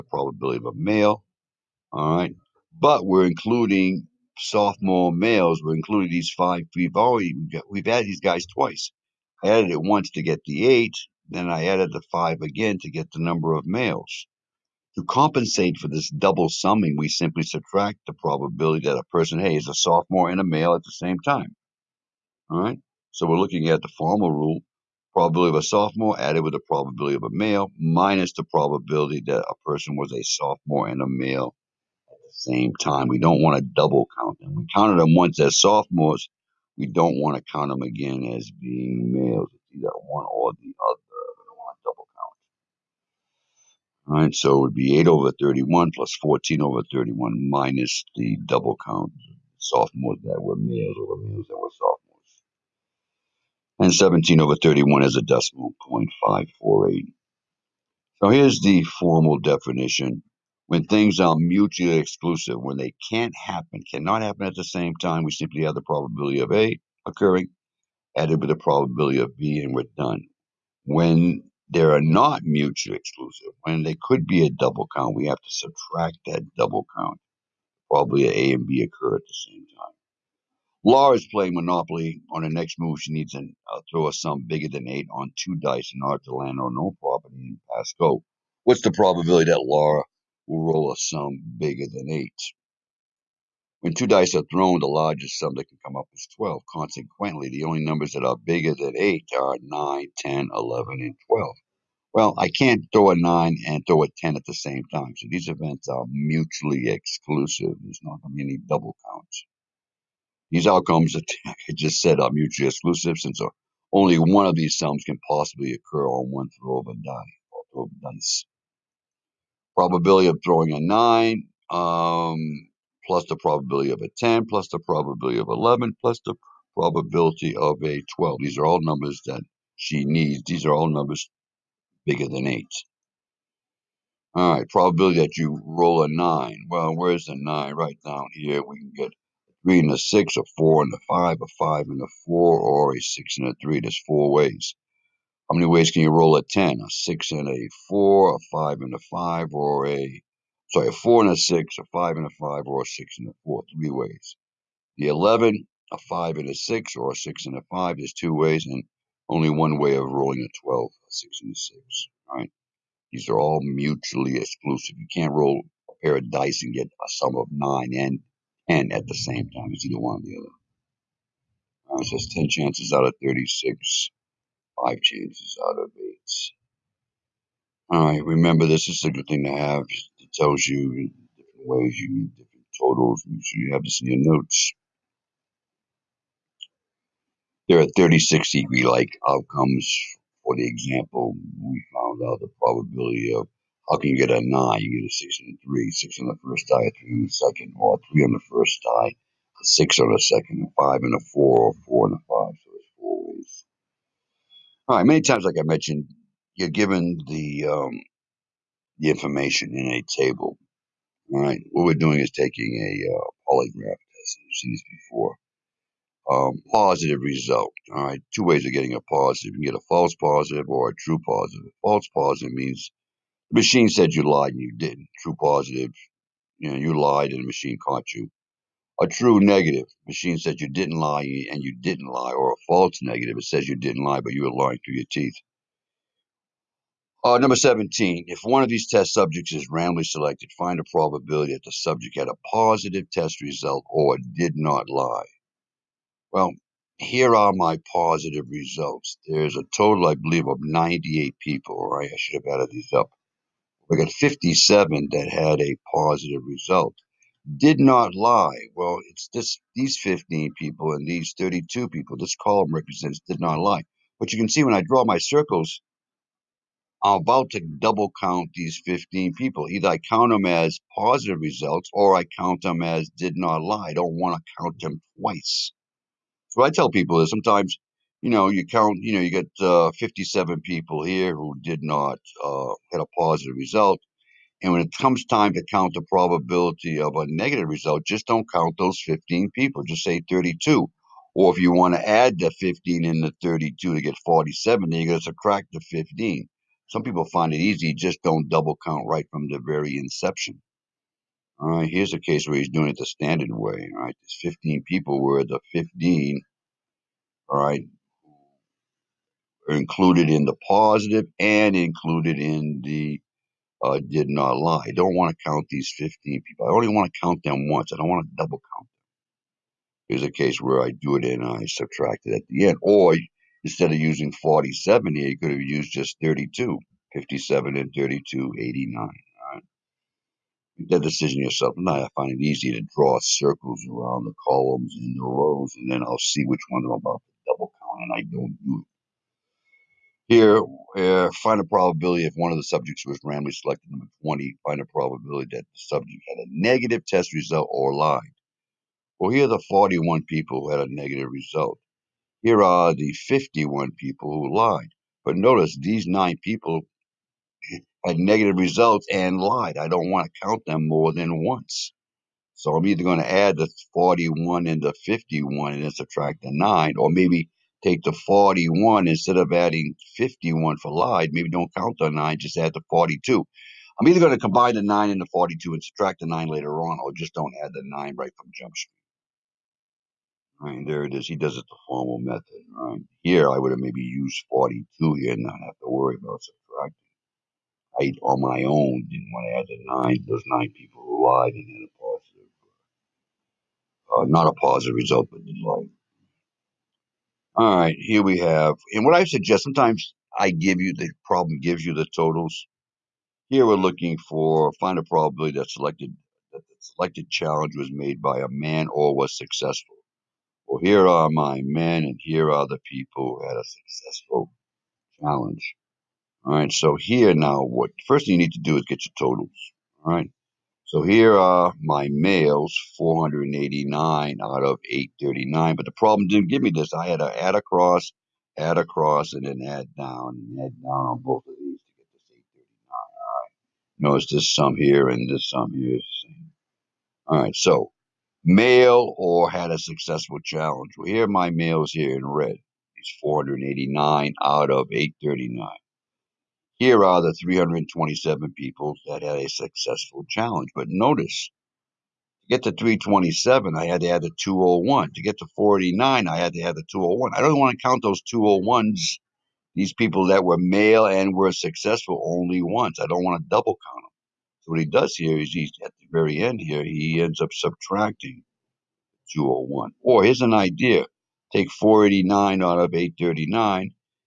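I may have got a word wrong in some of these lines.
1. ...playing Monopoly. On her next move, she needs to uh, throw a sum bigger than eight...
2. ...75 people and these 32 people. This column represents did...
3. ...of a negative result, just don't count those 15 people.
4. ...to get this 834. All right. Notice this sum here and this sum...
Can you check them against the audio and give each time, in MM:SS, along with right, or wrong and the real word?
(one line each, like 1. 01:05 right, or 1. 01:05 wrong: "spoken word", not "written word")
1. 01:21 right
2. 04:19 wrong: "15", not "75"
3. 04:47 right
4. 07:11 wrong: "839", not "834".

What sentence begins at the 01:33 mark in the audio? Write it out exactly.
When two dice are thrown, the largest sum that can come up is 12.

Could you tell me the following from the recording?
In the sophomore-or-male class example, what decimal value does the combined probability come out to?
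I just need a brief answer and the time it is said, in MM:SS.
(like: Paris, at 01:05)
0.548, at 00:56.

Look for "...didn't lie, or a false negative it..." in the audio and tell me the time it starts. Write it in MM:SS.
03:51.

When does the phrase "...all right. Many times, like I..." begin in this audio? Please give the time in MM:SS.
03:24.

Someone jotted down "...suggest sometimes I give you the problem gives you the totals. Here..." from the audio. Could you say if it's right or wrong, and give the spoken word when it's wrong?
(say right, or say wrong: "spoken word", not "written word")
right.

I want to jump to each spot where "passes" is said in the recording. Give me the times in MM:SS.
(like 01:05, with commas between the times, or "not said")
not said.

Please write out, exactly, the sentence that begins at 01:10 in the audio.
When they are not mutually exclusive, when they could be a double count, we have to subtract that double count.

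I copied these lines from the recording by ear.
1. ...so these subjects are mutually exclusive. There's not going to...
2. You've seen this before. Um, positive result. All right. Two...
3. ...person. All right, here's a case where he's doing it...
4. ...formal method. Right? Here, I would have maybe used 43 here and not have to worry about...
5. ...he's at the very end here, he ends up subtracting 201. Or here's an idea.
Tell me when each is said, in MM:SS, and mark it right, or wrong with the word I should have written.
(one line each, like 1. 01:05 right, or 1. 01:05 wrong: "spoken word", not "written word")
1. 01:45 wrong: "events", not "subjects"
2. 03:34 right
3. 04:59 wrong: "inception", not "person"
4. 06:21 wrong: "42", not "43"
5. 07:45 right.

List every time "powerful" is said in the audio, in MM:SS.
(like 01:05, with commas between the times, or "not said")
not said.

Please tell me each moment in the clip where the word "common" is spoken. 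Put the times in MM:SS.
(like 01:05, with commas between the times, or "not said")
not said.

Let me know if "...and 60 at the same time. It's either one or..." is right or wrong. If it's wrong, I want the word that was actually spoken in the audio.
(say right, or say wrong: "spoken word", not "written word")
wrong: "10", not "60".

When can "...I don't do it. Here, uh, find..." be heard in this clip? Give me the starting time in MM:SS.
05:38.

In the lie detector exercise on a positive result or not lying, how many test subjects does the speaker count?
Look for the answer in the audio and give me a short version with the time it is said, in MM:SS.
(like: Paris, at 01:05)
98, at 04:10.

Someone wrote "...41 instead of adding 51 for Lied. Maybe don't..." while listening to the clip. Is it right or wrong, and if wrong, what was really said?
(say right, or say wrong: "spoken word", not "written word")
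right.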